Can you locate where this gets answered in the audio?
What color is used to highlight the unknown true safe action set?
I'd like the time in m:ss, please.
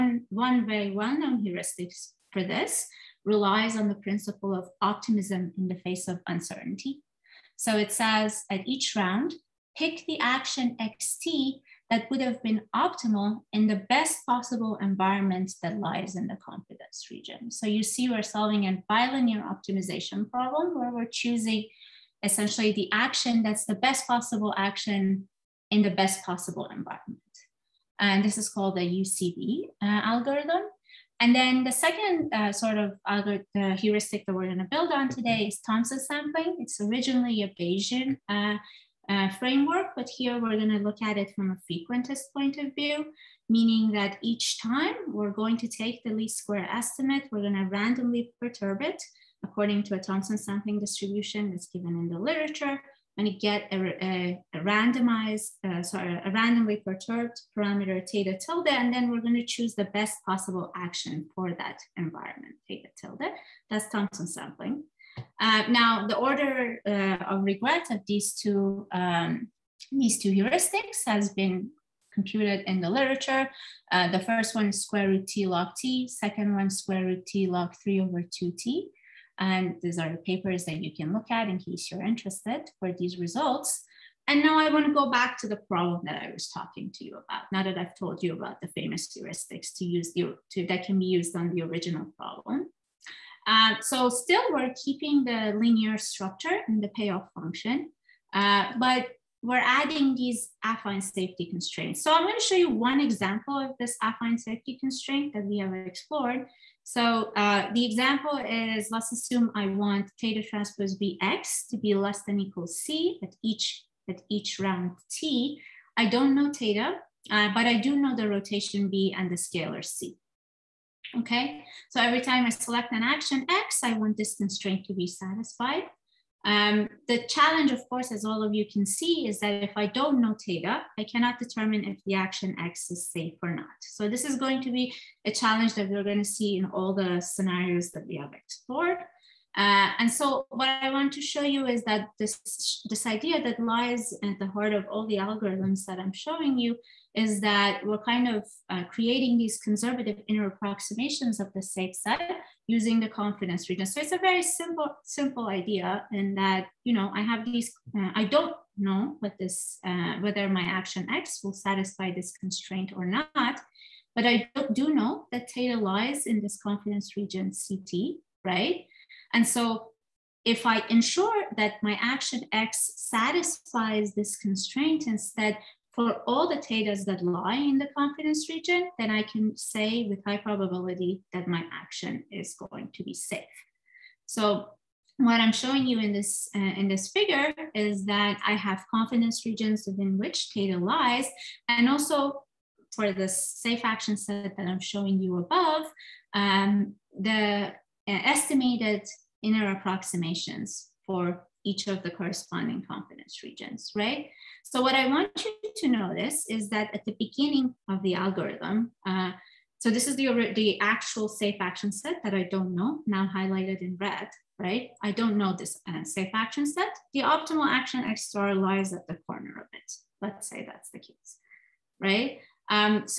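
3:33.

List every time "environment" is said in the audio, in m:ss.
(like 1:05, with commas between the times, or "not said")
0:14, 0:26, 1:01.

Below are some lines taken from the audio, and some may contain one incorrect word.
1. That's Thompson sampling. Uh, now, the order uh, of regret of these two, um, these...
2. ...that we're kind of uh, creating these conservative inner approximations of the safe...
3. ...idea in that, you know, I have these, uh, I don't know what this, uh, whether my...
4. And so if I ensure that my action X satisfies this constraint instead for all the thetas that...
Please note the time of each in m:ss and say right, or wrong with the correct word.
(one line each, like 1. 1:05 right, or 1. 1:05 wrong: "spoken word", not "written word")
1. 1:03 right
2. 2:27 right
3. 2:35 right
4. 2:49 right.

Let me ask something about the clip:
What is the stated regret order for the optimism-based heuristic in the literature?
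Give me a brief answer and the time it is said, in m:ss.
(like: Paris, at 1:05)
square root t log t, at 1:14.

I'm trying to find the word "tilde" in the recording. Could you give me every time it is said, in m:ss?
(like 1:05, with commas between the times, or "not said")
0:58, 1:02.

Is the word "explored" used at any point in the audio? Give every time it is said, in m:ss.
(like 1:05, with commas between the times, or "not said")
1:45, 2:18.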